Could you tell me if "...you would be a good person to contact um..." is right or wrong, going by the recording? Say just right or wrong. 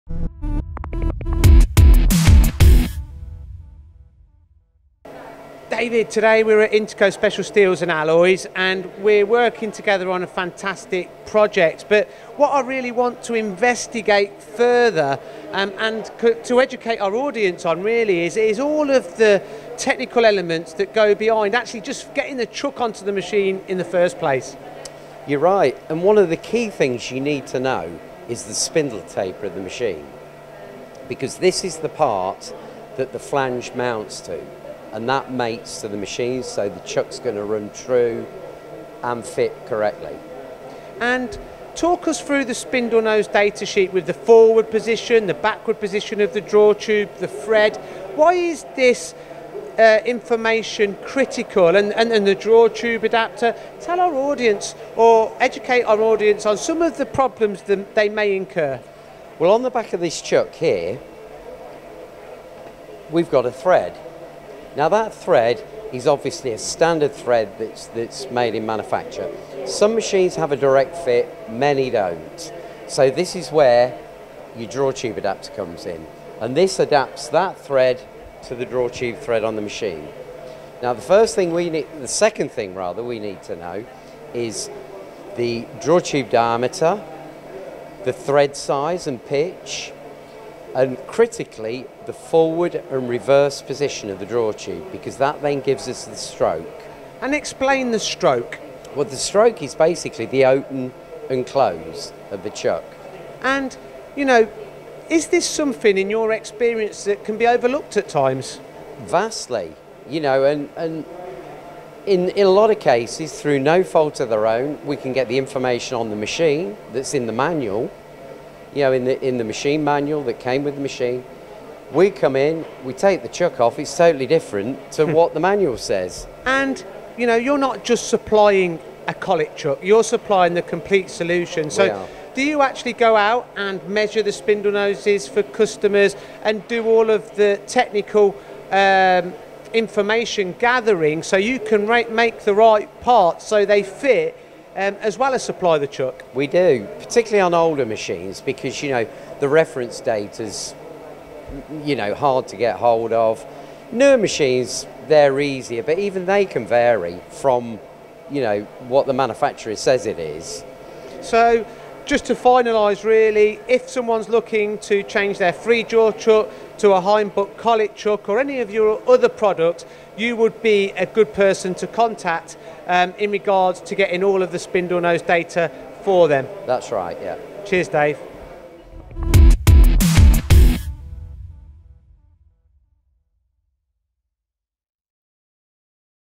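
right.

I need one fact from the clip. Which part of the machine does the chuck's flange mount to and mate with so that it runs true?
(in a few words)
Spindle taper.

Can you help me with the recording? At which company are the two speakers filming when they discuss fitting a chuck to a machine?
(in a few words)
Interco Special Steels and Alloys.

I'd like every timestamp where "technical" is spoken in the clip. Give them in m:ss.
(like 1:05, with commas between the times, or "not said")
0:19, 2:17.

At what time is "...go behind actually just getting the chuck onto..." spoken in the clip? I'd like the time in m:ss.
0:20.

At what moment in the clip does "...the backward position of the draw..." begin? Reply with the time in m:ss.
0:45.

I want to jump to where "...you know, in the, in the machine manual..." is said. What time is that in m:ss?
1:58.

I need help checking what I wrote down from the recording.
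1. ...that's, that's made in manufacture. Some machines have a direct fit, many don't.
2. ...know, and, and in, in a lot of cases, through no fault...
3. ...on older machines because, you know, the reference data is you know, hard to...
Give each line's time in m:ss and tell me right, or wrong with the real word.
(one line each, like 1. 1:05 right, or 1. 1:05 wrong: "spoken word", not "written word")
1. 1:07 right
2. 1:50 right
3. 2:27 right.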